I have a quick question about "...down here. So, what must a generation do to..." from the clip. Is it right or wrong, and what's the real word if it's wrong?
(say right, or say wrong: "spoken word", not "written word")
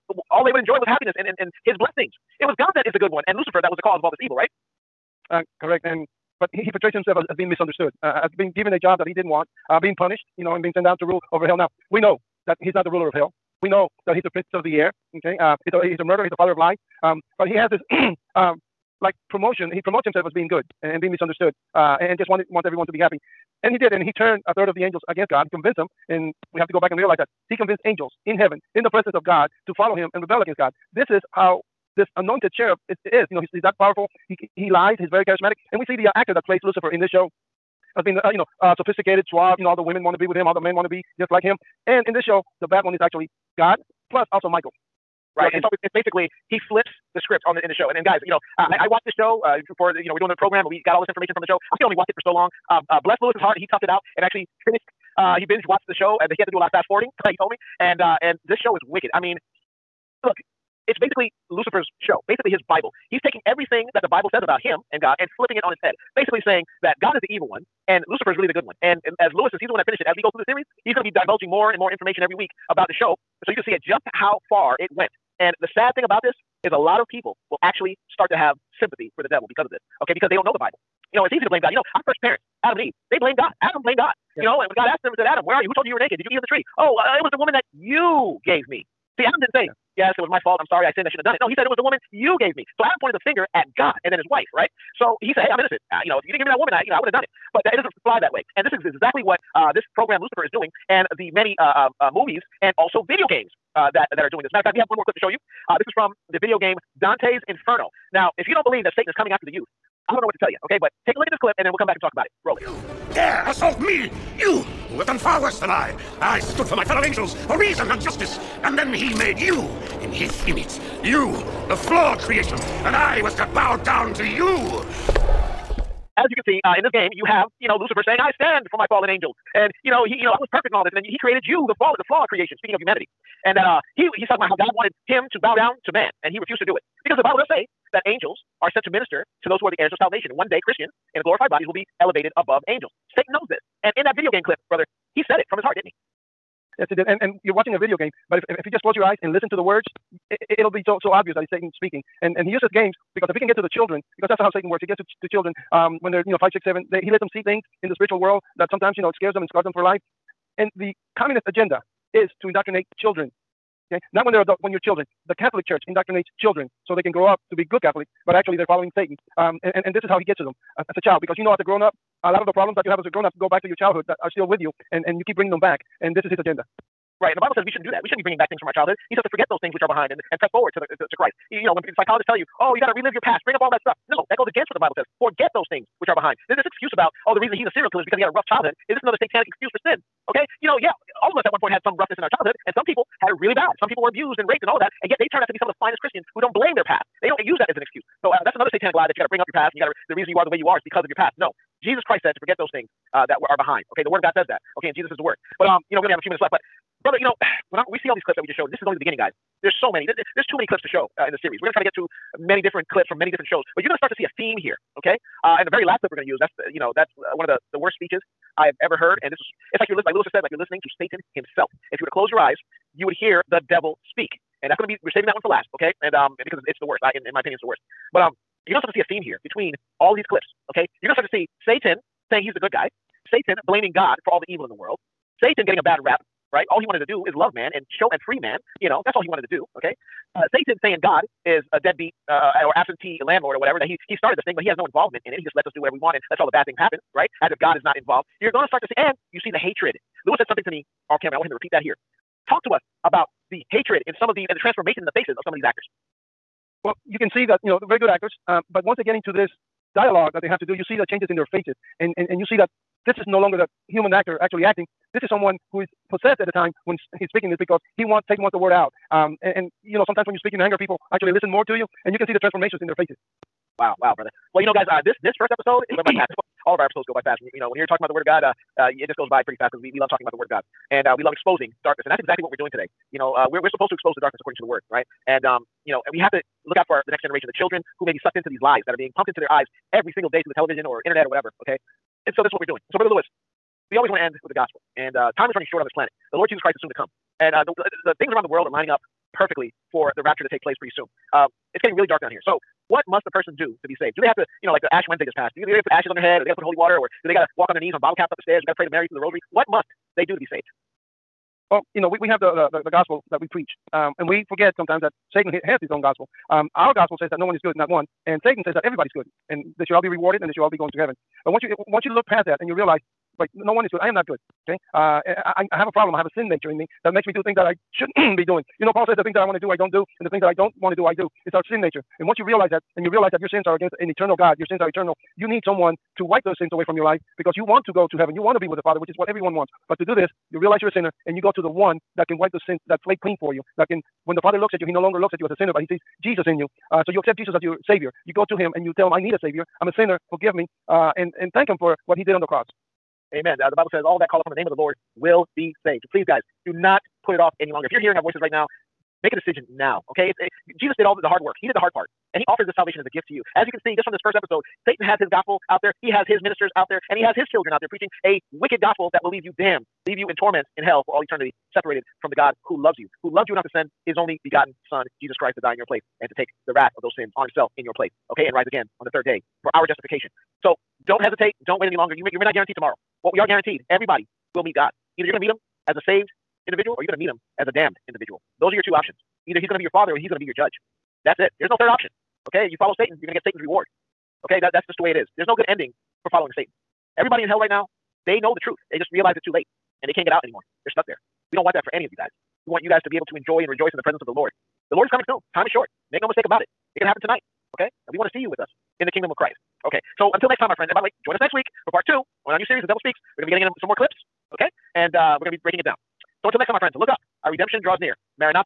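wrong: "person", not "generation".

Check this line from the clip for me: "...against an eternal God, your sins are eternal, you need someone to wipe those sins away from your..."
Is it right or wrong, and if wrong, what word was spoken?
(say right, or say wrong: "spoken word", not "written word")
right.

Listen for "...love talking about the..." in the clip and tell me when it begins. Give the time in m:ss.
4:39.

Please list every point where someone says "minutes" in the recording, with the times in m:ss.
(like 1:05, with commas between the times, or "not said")
3:26.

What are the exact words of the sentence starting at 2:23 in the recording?
Satan knows this, and in that video game clip, brother, he said it from his heart, didn't he?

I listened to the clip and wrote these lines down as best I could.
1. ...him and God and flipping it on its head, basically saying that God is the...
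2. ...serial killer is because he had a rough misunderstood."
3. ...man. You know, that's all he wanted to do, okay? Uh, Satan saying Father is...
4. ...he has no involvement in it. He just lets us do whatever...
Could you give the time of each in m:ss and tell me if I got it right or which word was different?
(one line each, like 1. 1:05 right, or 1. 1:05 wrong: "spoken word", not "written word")
1. 1:04 right
2. 3:07 wrong: "childhood", not "misunderstood"
3. 3:58 wrong: "God", not "Father"
4. 4:04 right.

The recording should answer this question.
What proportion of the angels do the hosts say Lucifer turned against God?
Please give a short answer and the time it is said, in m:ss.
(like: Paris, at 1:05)
a third, at 0:24.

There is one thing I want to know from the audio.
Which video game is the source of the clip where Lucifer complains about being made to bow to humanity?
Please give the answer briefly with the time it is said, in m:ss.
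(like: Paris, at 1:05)
Dante's Inferno, at 1:47.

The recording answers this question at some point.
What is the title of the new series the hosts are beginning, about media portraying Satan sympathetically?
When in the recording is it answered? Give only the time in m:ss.
6:52.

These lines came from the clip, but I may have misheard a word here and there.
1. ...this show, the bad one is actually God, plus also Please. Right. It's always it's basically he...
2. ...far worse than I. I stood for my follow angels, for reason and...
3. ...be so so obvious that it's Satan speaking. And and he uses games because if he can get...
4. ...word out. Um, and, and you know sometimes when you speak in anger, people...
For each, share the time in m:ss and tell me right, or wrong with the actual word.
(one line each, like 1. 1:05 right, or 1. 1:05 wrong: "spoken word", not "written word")
1. 0:42 wrong: "Michael", not "Please"
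2. 1:55 wrong: "fellow", not "follow"
3. 2:30 right
4. 4:28 right.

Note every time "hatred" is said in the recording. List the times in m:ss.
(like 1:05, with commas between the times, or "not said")
4:09, 4:13.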